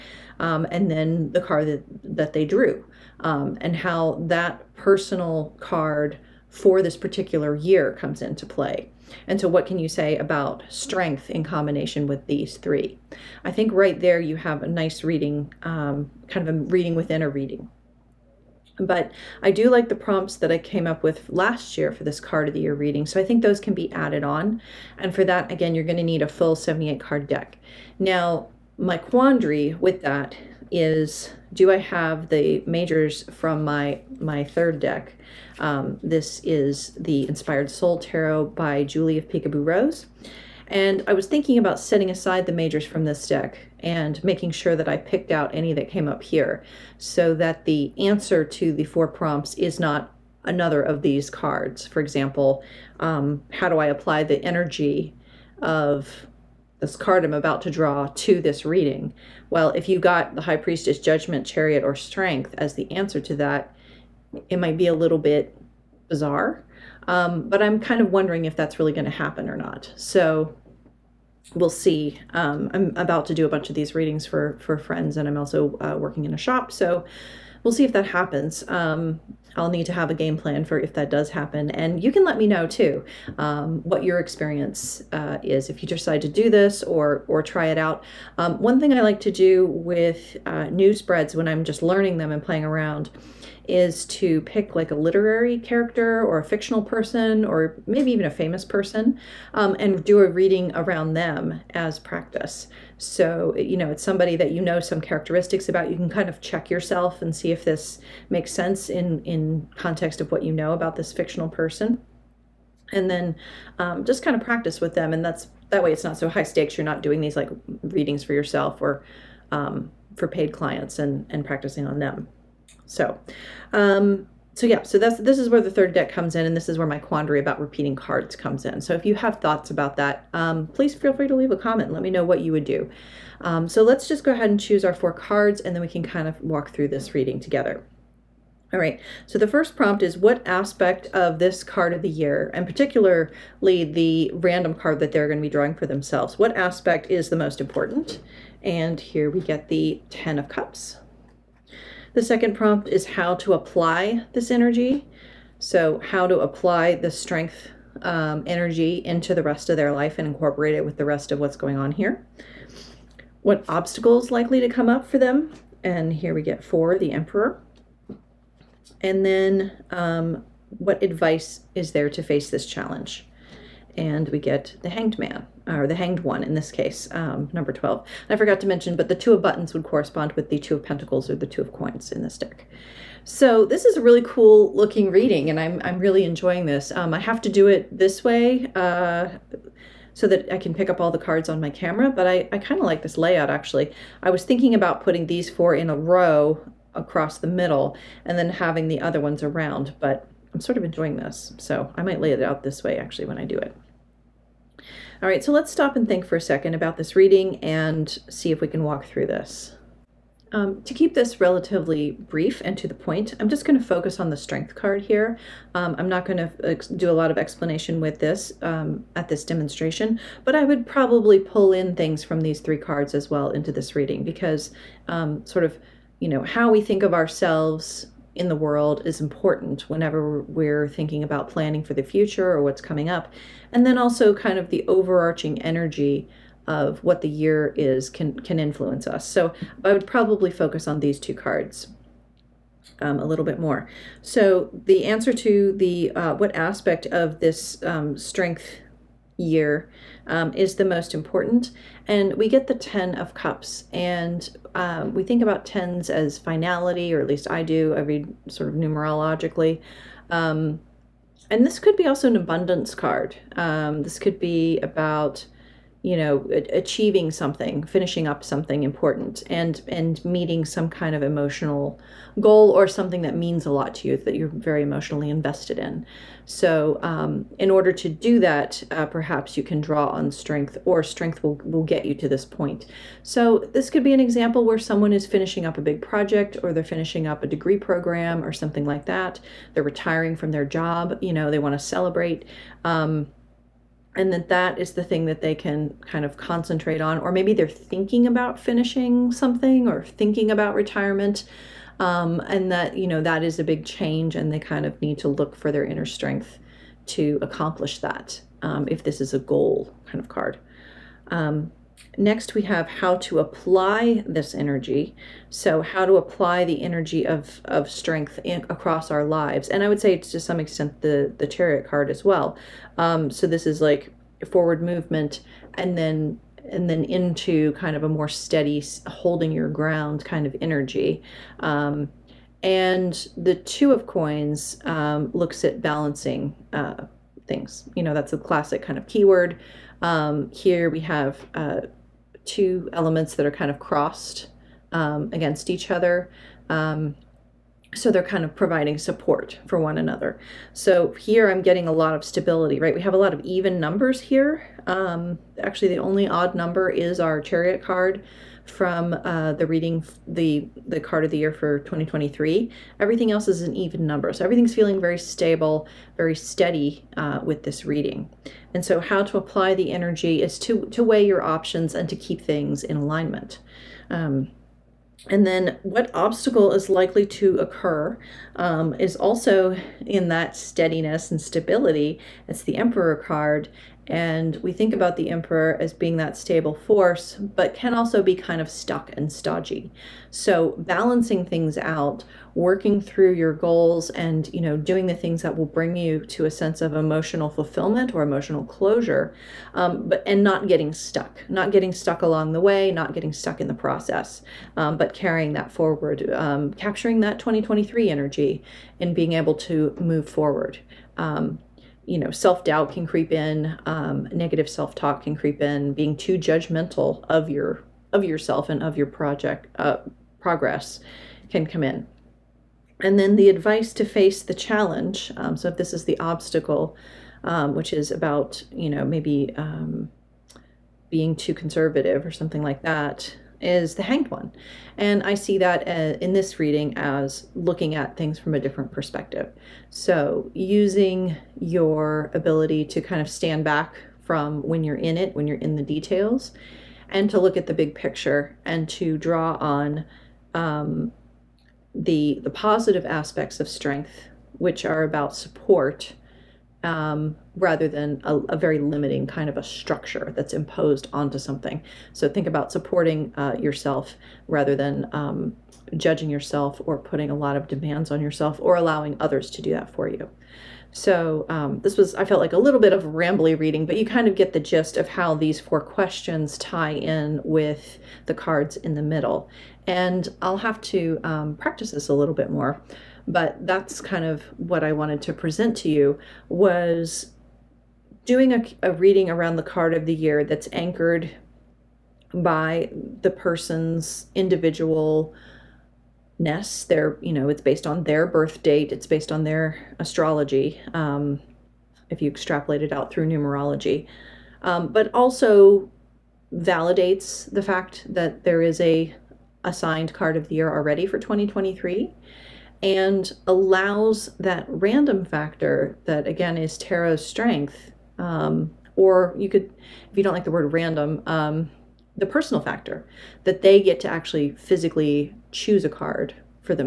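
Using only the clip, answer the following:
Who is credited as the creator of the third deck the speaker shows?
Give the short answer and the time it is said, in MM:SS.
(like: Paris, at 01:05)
Julie of Peekaboo Rose, at 00:38.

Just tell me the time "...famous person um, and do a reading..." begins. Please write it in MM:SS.
01:38.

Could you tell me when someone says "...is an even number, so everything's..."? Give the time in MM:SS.
06:03.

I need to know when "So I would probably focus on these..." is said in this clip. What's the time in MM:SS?
03:59.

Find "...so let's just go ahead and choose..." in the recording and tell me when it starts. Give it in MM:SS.
02:13.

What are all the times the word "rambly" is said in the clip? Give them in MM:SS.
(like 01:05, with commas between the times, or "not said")
07:53.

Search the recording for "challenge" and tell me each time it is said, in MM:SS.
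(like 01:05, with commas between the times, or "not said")
02:52, 07:04.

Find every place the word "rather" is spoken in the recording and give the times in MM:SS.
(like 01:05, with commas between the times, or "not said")
07:37, 07:44.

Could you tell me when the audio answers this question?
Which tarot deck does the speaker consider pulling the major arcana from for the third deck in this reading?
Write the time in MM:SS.
00:37.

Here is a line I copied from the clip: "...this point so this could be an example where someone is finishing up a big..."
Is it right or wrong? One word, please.
right.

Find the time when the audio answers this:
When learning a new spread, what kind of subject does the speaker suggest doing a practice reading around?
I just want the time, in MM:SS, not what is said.
01:34.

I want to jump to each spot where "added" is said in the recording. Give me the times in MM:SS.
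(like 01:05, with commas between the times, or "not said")
00:23.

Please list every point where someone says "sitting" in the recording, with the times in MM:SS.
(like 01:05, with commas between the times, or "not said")
not said.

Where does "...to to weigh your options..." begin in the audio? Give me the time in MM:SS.
06:10.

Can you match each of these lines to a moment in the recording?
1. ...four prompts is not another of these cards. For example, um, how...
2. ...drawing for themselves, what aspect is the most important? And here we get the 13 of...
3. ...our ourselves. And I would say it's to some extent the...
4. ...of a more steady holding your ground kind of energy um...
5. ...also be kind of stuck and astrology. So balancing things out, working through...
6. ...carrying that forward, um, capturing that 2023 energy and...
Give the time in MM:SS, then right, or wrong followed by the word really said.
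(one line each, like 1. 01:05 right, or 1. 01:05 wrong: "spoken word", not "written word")
1. 00:48 right
2. 02:25 wrong: "10", not "13"
3. 05:19 wrong: "lives", not "ourselves"
4. 05:27 right
5. 06:27 wrong: "stodgy", not "astrology"
6. 06:45 right.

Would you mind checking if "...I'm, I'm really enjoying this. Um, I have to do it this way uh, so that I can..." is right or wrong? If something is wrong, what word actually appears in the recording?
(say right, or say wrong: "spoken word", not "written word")
right.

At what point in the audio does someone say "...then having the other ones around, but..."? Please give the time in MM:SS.
03:18.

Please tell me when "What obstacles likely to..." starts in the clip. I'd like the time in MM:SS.
02:43.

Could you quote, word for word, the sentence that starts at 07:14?
And I see that uh, in this reading as looking at things from a different perspective.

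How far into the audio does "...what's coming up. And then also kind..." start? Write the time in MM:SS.
03:52.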